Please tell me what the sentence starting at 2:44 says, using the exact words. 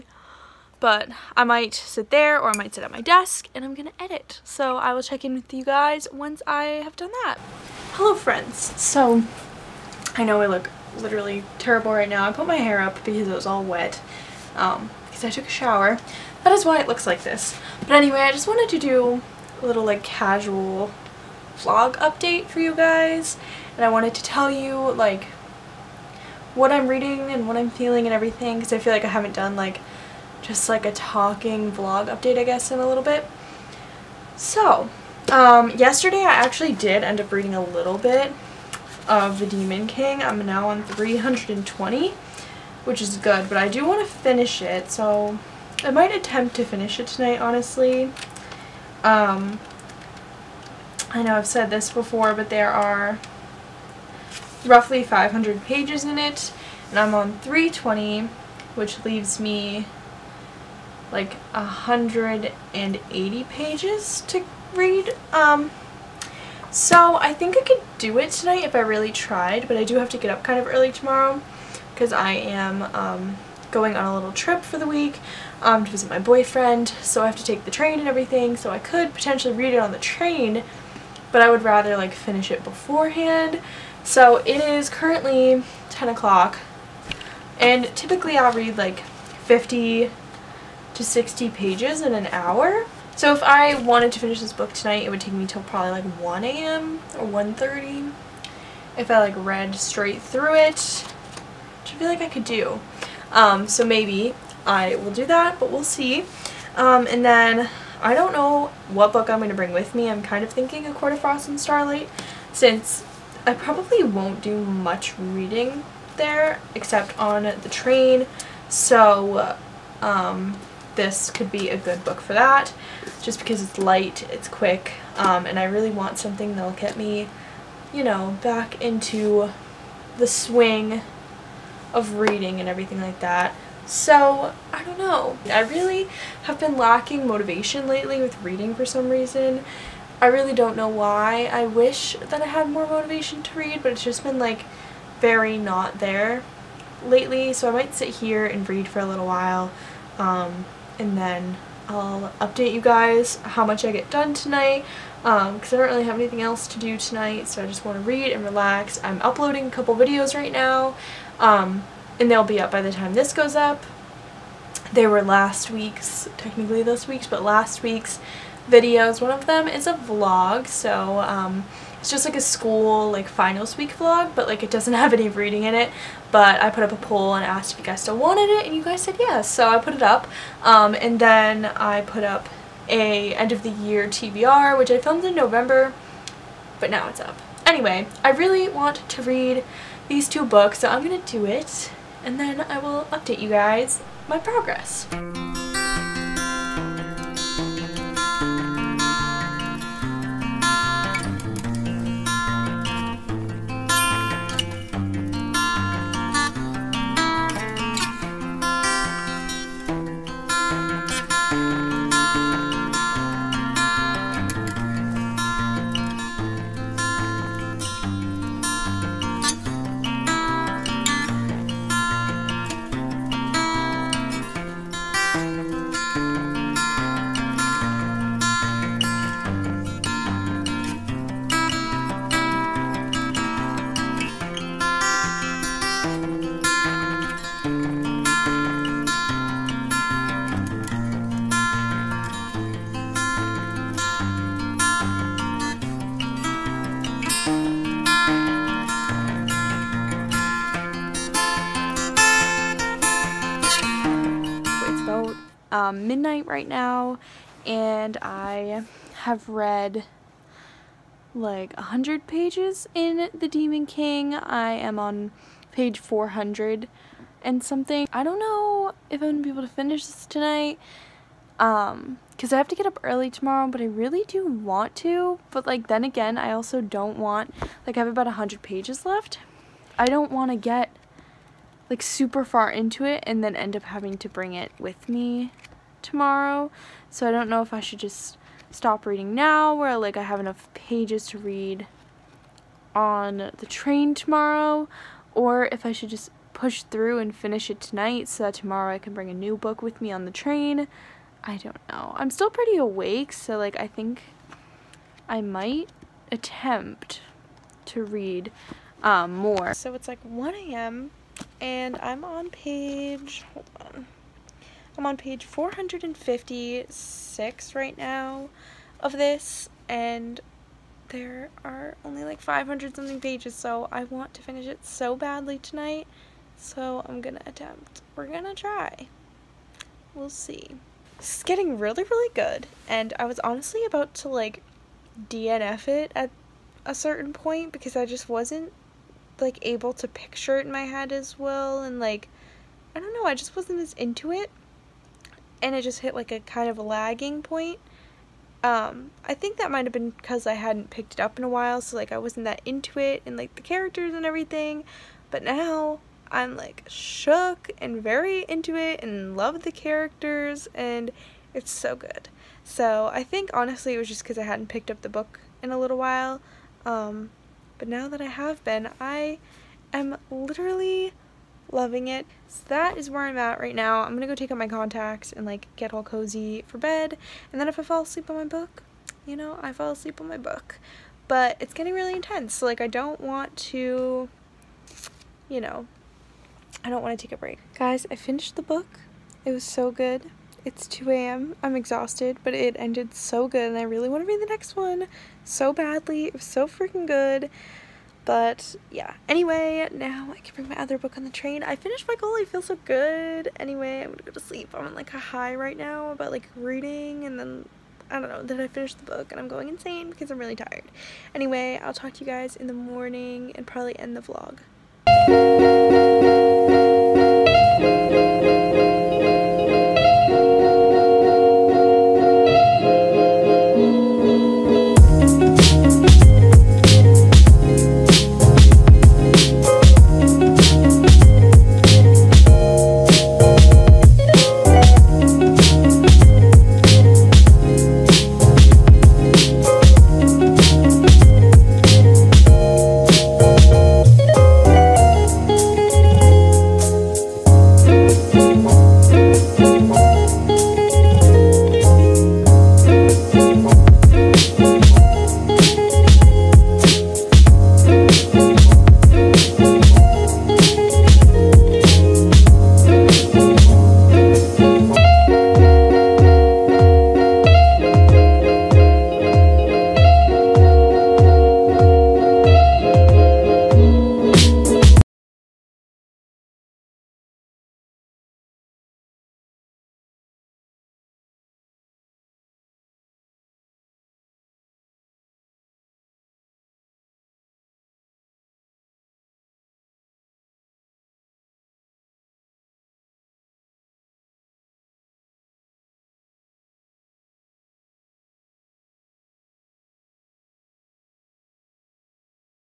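They were last week's, technically this week's, but last week's videos.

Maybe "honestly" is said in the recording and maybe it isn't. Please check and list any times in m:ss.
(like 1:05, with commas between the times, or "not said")
0:47, 5:33, 6:03.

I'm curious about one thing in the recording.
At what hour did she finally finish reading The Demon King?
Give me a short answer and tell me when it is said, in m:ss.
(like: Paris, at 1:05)
2 a.m., at 6:30.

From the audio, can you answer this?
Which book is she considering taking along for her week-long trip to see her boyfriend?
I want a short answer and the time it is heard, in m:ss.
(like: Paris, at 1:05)
A Court of Frost and Starlight, at 1:50.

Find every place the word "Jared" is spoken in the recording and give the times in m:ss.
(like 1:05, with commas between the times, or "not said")
not said.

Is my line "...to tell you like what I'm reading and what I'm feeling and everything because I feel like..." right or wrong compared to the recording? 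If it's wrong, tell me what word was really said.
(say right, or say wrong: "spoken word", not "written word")
right.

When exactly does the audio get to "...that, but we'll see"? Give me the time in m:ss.
1:45.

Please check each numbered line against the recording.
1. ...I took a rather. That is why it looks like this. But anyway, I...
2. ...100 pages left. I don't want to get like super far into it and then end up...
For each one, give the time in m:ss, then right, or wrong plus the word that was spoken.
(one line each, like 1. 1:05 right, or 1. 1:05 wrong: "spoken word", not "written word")
1. 0:15 wrong: "shower", not "rather"
2. 4:38 right.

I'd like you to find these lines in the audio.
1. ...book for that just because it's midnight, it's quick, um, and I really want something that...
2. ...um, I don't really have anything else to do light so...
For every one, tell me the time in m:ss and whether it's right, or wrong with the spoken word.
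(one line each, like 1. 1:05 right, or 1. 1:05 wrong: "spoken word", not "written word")
1. 2:02 wrong: "light", not "midnight"
2. 2:35 wrong: "tonight", not "light".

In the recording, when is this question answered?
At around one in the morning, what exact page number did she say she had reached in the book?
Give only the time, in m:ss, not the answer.
5:15.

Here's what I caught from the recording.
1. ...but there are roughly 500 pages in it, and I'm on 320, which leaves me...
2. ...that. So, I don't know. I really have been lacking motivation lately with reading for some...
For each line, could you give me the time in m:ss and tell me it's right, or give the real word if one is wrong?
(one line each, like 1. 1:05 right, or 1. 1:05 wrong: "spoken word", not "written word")
1. 0:52 right
2. 2:13 right.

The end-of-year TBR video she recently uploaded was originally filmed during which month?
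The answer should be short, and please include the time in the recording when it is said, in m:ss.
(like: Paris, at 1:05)
November, at 3:04.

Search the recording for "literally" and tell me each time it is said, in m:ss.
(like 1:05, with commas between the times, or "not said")
0:10, 6:10.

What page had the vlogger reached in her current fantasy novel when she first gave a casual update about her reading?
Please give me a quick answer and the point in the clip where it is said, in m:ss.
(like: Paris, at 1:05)
320, at 0:40.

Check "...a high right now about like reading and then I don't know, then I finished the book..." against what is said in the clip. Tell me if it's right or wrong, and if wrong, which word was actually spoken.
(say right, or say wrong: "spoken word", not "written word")
right.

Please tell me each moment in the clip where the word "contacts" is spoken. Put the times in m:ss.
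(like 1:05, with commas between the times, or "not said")
6:14.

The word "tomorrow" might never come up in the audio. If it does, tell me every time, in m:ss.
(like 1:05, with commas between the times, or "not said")
1:10, 4:33, 4:46, 4:54, 4:58.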